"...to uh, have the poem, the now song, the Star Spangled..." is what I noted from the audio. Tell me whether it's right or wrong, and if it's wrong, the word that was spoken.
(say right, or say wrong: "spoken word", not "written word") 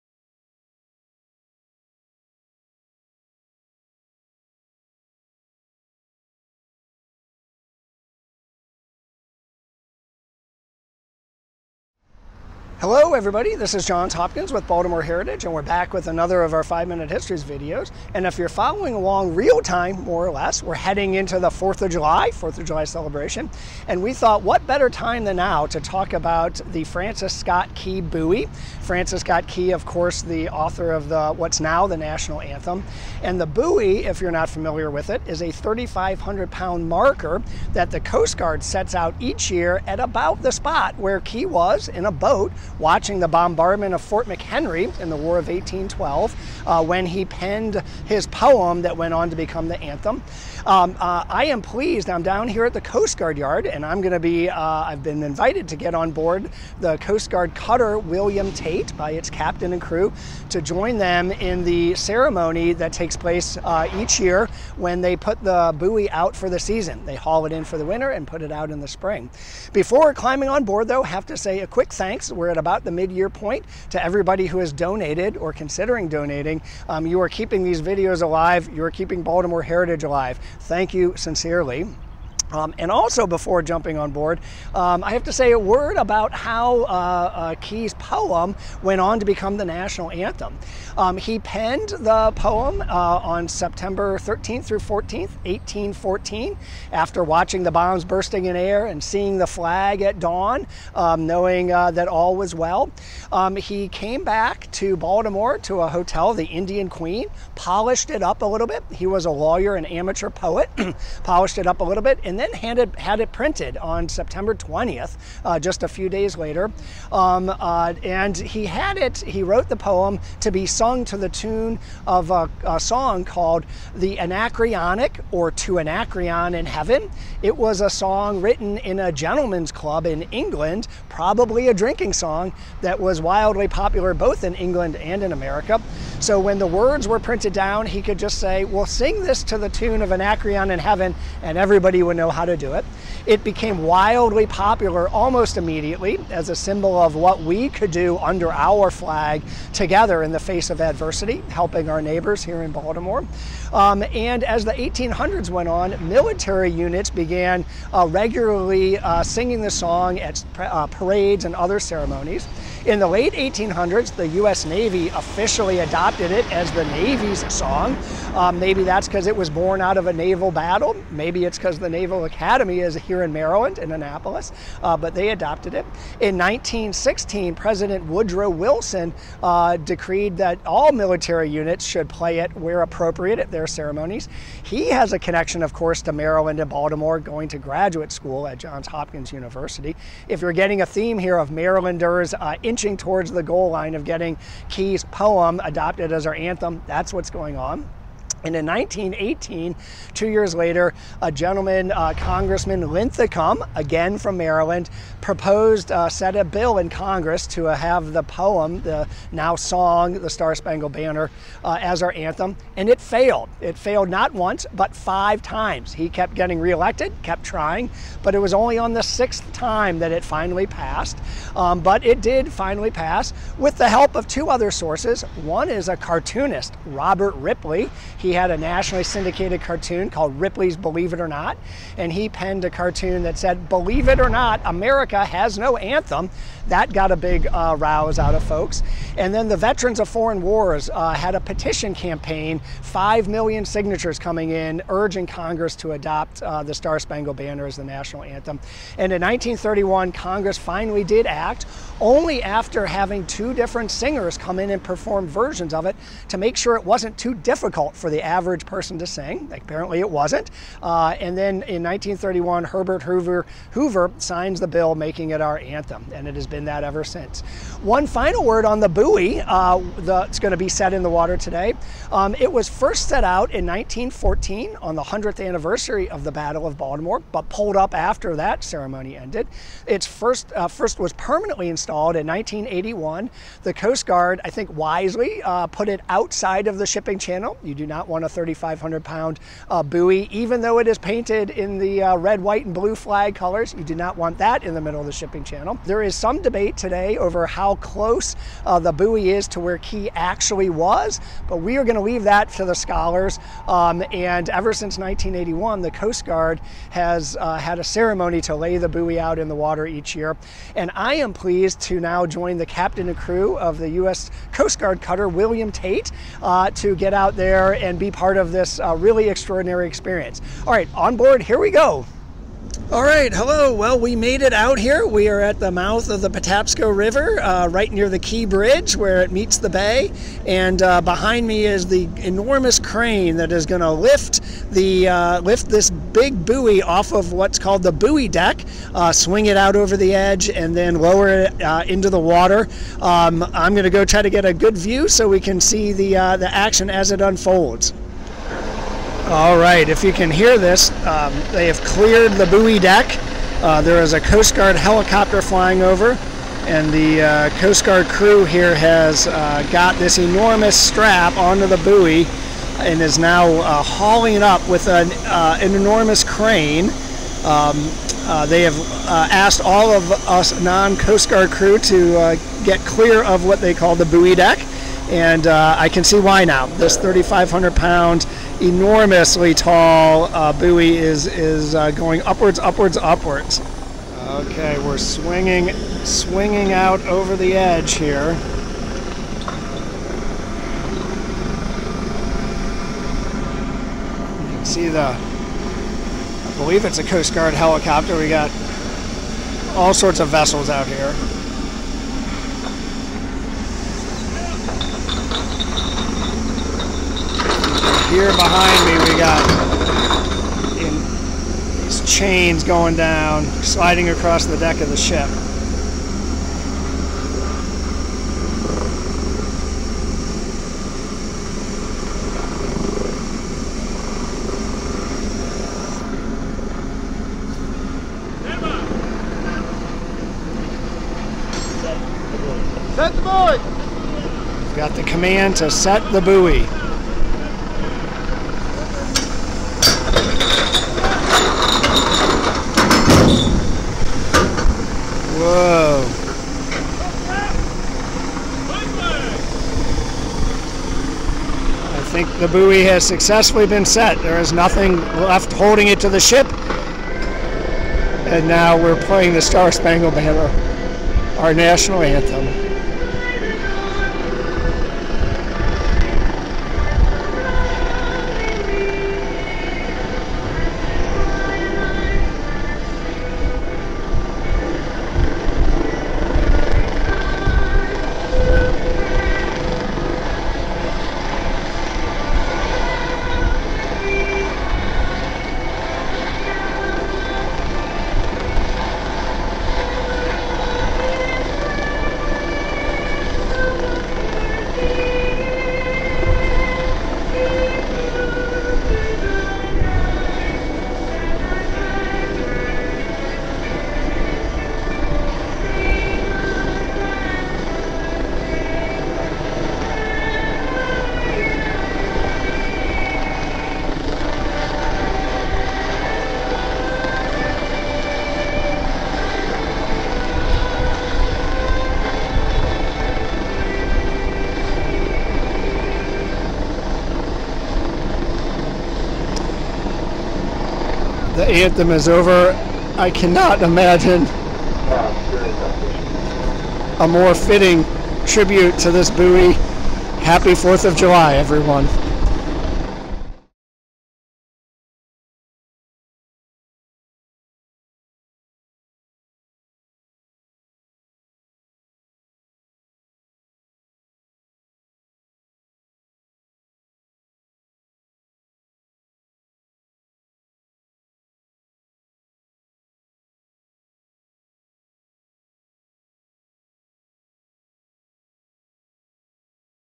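right.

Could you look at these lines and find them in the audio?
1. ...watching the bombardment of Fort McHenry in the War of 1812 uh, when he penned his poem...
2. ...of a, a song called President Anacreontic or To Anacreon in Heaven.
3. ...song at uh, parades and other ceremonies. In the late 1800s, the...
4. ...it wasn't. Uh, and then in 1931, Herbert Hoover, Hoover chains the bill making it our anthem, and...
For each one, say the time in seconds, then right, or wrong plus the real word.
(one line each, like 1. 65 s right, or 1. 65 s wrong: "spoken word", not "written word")
1. 42 s right
2. 122 s wrong: "The", not "President"
3. 159 s right
4. 259 s wrong: "signs", not "chains".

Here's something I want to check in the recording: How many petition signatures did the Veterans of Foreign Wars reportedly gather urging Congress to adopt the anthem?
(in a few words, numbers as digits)
5 million.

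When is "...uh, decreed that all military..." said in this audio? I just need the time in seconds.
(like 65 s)
179 s.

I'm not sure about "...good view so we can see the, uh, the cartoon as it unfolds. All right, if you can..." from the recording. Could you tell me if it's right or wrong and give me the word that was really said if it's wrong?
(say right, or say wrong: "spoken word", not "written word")
wrong: "action", not "cartoon".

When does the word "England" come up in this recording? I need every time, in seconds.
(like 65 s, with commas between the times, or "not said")
130 s, 134 s.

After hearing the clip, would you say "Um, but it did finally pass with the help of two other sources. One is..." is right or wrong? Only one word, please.
right.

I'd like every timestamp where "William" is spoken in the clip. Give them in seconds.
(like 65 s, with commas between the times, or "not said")
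57 s, 315 s.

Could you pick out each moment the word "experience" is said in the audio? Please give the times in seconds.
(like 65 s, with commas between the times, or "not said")
319 s.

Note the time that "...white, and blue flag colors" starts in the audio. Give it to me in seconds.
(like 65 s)
292 s.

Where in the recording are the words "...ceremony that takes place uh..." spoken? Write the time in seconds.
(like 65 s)
61 s.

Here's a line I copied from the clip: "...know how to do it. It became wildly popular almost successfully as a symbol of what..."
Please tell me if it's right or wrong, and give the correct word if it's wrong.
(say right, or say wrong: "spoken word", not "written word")
wrong: "immediately", not "successfully".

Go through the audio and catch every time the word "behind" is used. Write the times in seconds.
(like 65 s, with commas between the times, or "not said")
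331 s, 408 s.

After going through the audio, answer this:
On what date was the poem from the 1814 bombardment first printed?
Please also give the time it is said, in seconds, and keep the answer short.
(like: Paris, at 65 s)
September 20, at 114 s.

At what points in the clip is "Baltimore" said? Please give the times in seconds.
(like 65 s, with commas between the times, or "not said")
14 s, 79 s, 104 s, 152 s, 186 s, 276 s.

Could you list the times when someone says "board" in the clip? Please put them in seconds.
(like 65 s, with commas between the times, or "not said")
56 s, 70 s, 84 s, 321 s.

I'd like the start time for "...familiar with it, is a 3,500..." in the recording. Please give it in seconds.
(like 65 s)
34 s.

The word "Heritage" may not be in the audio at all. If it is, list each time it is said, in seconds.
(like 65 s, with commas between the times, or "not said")
15 s, 79 s.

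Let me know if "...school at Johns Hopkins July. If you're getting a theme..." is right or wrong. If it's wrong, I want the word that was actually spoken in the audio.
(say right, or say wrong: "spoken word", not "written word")
wrong: "University", not "July".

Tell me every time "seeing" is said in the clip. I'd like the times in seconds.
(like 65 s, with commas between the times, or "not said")
99 s.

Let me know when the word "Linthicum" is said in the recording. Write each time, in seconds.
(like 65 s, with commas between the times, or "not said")
202 s.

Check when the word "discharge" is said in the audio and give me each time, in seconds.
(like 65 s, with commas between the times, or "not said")
not said.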